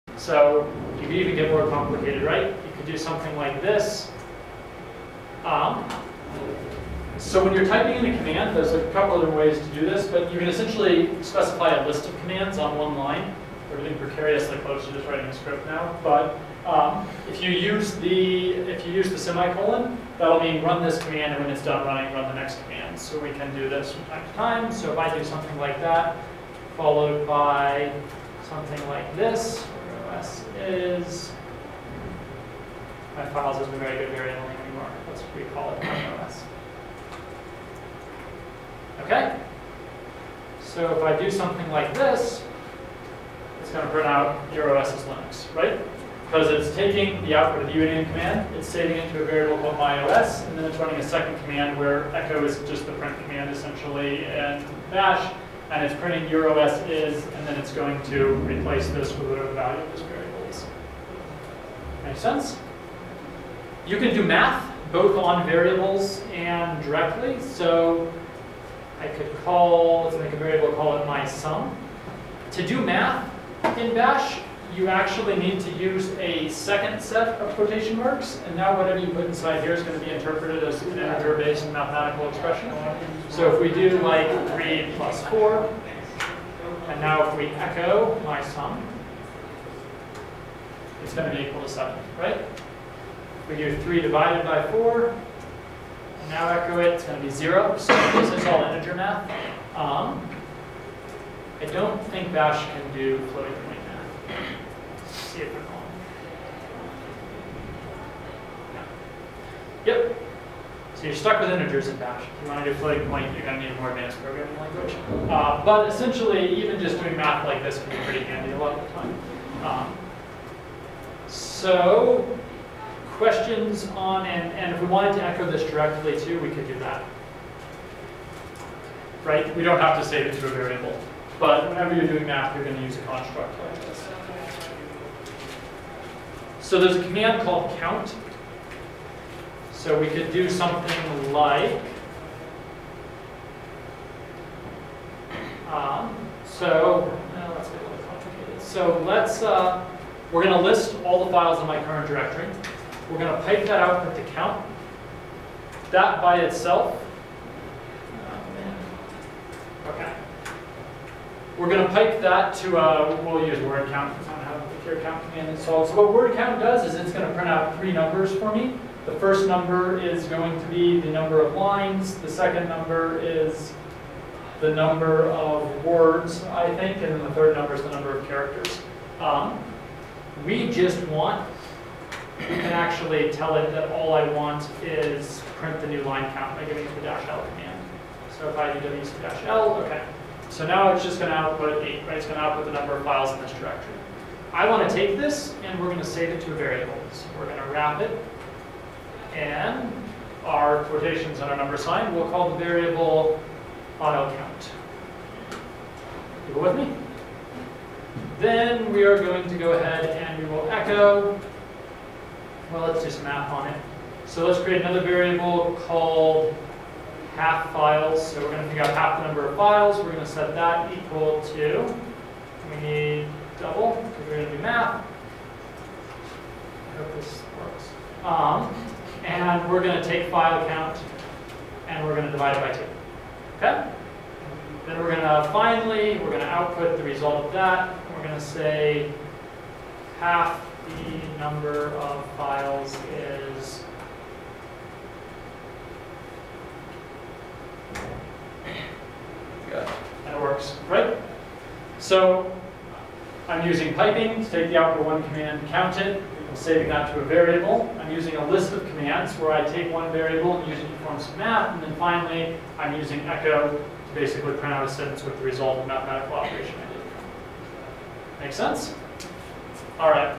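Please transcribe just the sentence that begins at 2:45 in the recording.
So what word count does is it's going to print out three numbers for me.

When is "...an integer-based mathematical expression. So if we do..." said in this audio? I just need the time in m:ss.
1:20.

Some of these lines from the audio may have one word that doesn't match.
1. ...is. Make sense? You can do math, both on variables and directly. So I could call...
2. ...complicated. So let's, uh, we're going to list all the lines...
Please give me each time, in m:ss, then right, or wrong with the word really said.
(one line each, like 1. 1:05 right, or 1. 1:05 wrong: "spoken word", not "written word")
1. 1:00 right
2. 2:28 wrong: "files", not "lines".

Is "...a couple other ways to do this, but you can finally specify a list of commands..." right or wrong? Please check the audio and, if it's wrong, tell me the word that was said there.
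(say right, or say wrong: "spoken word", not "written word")
wrong: "essentially", not "finally".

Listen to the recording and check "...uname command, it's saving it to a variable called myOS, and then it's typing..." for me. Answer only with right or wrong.
wrong.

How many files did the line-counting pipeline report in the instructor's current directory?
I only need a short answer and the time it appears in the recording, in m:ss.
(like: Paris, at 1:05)
8, at 3:11.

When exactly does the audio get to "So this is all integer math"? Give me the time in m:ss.
1:37.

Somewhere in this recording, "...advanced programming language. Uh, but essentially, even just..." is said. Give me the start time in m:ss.
1:53.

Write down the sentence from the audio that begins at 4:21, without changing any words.
And then finally, I'm using echo to basically print out a sentence with the result of mathematical operation I did.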